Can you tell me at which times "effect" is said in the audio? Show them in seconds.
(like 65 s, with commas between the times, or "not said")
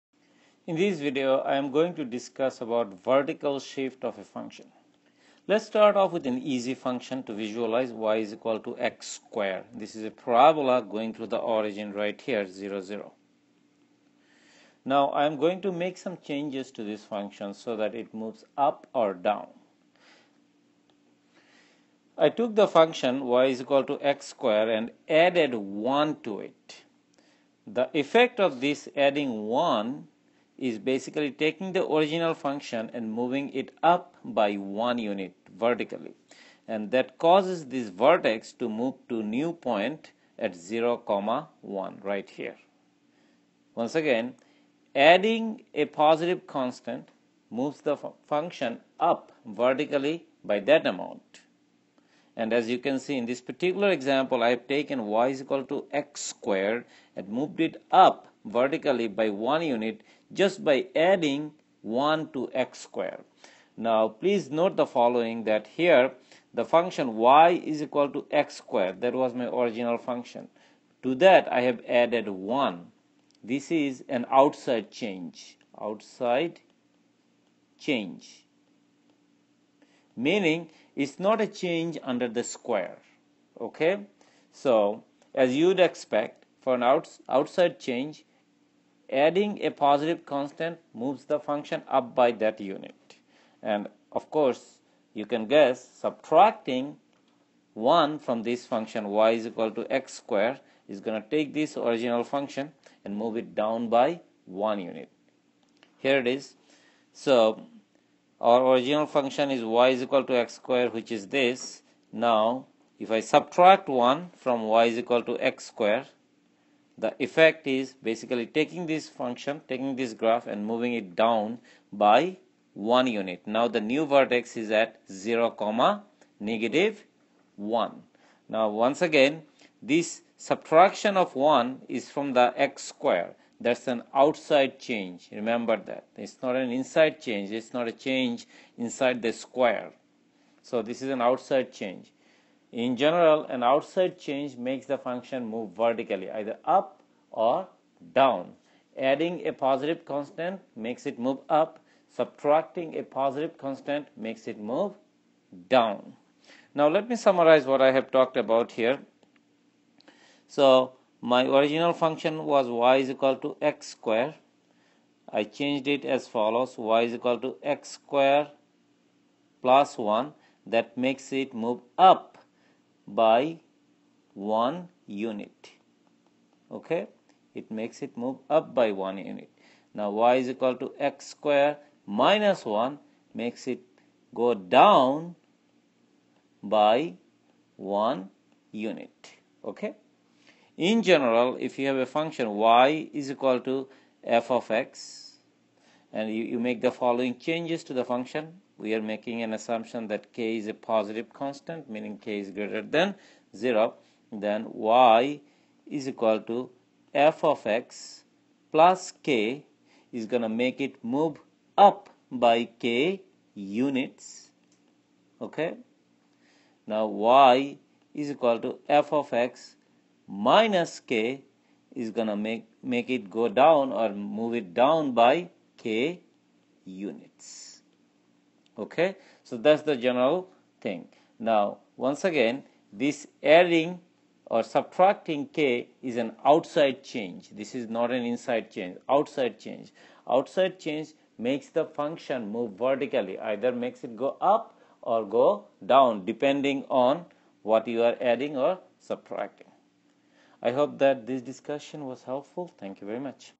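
27 s, 117 s.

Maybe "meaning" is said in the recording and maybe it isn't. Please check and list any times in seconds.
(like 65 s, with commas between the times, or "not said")
80 s, 201 s.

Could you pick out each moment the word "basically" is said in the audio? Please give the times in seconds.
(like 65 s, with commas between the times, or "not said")
30 s, 118 s.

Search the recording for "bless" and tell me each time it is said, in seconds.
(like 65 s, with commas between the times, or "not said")
not said.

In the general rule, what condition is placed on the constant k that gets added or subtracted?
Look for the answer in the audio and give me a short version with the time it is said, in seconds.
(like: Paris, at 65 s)
k is greater than 0, at 202 s.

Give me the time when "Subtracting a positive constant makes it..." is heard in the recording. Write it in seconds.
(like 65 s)
152 s.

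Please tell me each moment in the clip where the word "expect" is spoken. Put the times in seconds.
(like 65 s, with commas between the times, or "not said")
85 s.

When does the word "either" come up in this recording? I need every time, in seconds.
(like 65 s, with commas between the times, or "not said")
146 s, 243 s.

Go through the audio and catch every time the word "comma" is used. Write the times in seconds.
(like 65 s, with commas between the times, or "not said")
41 s, 125 s.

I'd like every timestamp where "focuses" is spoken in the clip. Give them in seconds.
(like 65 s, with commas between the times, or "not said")
not said.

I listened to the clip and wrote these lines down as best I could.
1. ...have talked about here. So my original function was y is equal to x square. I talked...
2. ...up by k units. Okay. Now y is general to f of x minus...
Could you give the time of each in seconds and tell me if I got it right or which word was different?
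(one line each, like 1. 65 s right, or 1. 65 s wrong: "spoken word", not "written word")
1. 157 s wrong: "changed", not "talked"
2. 211 s wrong: "equal", not "general".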